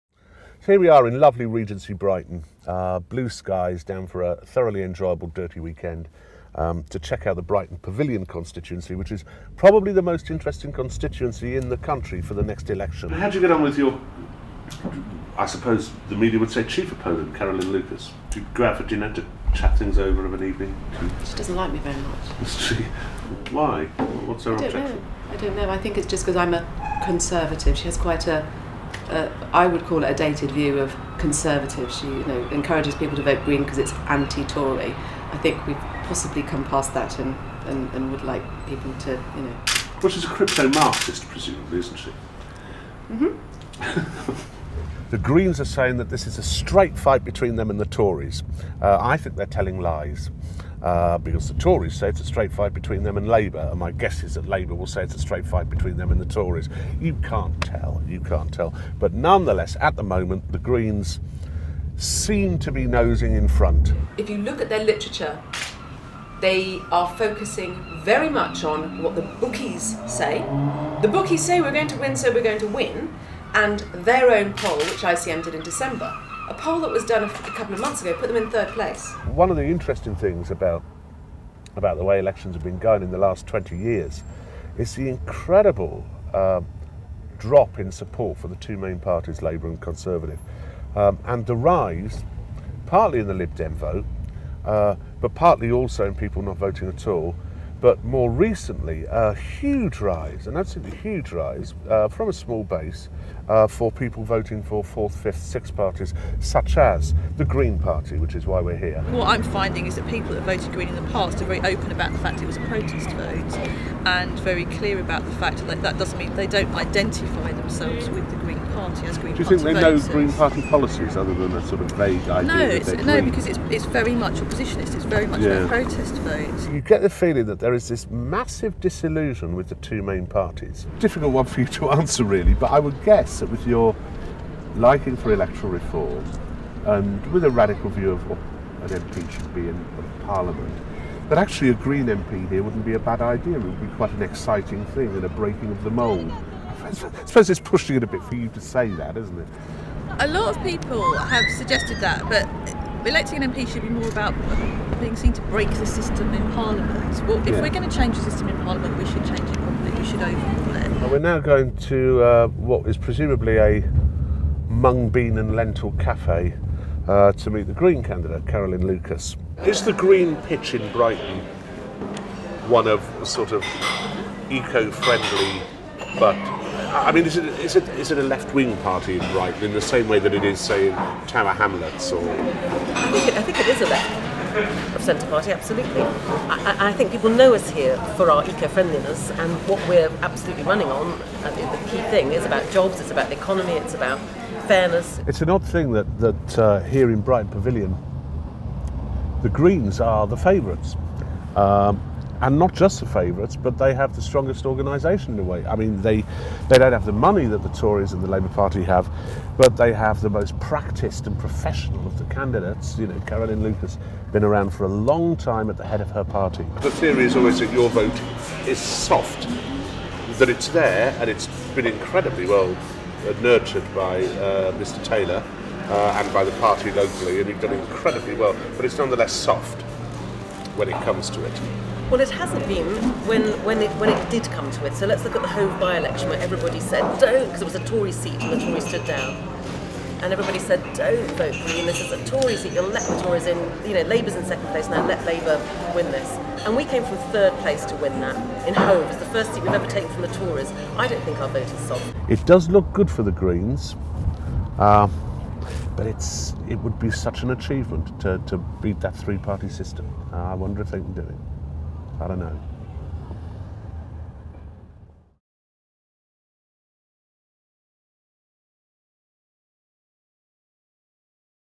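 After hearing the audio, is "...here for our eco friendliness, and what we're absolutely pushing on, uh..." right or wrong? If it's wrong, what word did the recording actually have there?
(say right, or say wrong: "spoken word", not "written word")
wrong: "running", not "pushing".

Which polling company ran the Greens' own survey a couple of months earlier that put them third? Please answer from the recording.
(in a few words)
ICM.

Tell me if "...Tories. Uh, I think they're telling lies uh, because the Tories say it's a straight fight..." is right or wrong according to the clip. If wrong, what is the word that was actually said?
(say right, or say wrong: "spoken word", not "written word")
right.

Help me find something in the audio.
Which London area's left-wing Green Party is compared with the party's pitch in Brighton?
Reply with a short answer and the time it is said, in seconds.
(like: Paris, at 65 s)
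Tower Hamlets, at 181 s.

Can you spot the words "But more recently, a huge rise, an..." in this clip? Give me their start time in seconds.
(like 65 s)
97 s.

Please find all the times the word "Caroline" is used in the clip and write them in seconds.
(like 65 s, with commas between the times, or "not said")
17 s, 168 s, 213 s.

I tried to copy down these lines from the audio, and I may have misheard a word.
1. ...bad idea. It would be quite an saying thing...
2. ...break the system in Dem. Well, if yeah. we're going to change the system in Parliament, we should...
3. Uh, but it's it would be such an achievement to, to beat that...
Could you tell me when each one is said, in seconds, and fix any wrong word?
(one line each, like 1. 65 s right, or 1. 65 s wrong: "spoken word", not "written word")
1. 142 s wrong: "exciting", not "saying"
2. 155 s wrong: "Parliament", not "Dem"
3. 254 s right.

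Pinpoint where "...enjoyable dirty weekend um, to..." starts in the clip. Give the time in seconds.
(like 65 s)
4 s.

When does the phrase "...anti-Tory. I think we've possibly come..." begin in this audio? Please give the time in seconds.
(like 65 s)
34 s.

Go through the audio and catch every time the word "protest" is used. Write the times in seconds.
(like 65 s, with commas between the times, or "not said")
112 s, 125 s.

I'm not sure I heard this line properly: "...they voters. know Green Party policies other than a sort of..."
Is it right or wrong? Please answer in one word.
right.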